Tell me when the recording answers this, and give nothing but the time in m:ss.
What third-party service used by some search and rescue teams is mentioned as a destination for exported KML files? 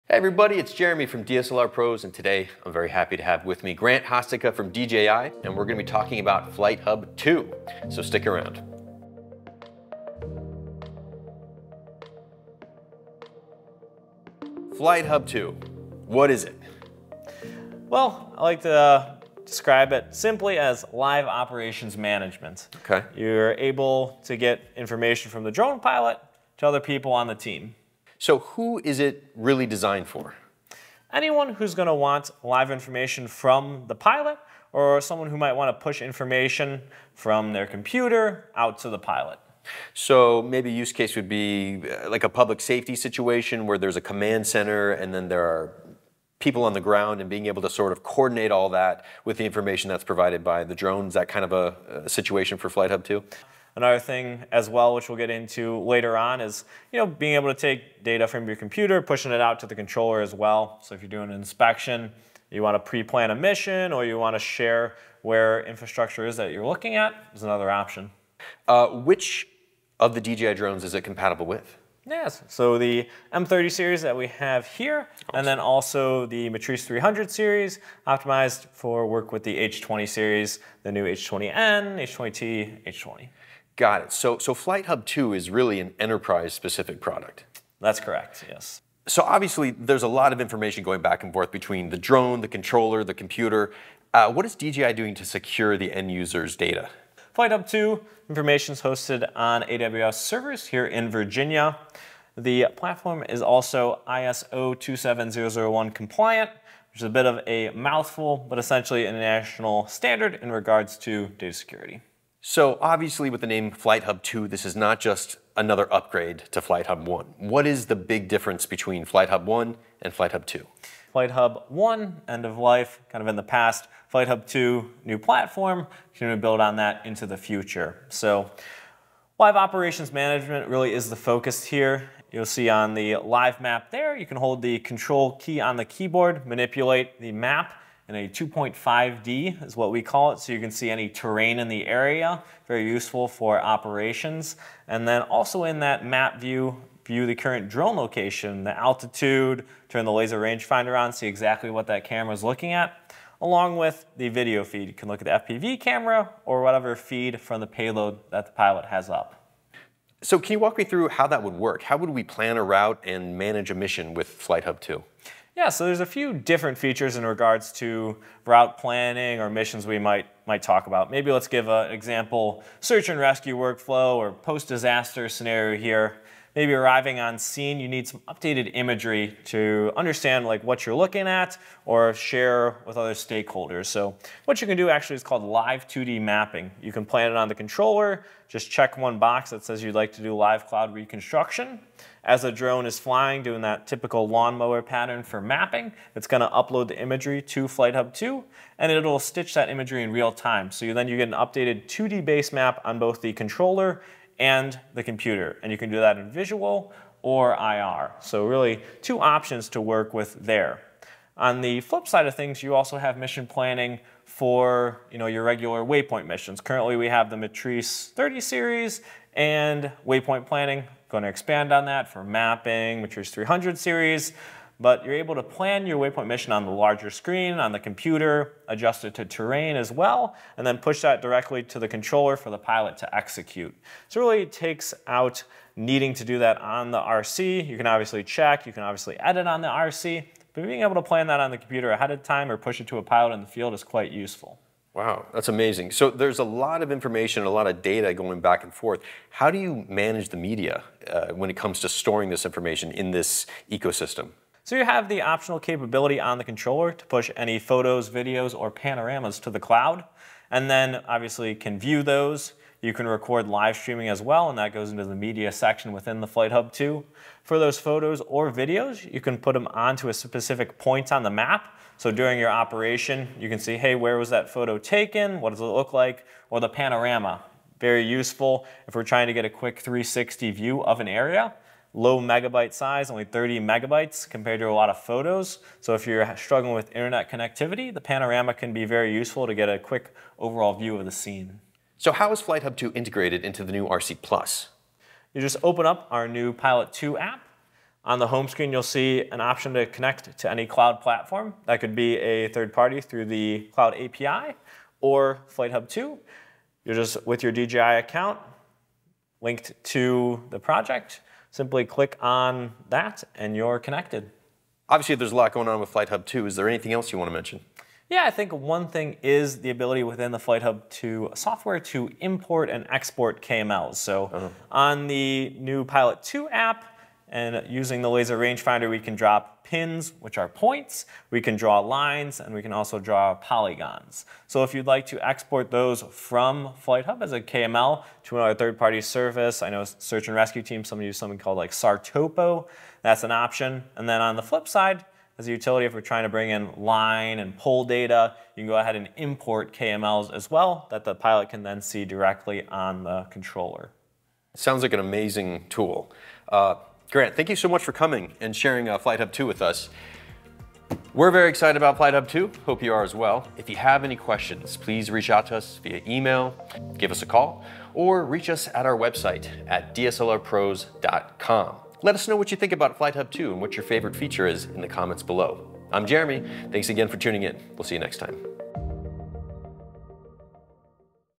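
5:41.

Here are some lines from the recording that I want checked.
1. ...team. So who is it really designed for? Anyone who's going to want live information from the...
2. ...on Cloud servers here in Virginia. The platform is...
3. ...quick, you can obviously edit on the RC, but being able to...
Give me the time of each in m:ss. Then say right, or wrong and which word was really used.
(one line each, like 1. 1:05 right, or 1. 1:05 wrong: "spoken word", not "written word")
1. 0:27 right
2. 1:39 wrong: "AWS", not "Cloud"
3. 3:58 wrong: "check", not "quick".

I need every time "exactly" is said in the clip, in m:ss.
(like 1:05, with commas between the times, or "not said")
2:31.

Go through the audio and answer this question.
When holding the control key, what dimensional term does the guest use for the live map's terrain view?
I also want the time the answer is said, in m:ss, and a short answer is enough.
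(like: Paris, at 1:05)
2.5D, at 2:18.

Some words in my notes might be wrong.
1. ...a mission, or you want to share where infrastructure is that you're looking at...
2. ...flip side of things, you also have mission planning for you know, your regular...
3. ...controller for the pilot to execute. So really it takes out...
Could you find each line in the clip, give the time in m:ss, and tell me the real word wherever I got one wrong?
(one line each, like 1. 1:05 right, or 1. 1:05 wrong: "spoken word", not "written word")
1. 1:03 right
2. 3:31 right
3. 3:51 right.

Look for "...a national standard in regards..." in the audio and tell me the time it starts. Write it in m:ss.
1:49.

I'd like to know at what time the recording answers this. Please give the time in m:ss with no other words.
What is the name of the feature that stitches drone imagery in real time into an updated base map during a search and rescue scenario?
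3:05.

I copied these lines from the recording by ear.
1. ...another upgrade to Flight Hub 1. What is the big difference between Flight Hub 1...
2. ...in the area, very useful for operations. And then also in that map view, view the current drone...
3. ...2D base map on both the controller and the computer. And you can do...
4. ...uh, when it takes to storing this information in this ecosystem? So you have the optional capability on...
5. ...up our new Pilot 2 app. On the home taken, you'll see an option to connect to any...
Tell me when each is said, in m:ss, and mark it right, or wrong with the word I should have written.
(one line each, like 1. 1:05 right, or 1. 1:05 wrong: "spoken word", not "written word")
1. 1:55 right
2. 2:21 right
3. 3:21 right
4. 4:11 wrong: "comes", not "takes"
5. 4:55 wrong: "screen", not "taken".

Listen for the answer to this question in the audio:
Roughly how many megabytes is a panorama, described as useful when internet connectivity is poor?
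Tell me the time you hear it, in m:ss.
4:43.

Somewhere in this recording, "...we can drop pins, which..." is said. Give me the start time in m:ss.
5:28.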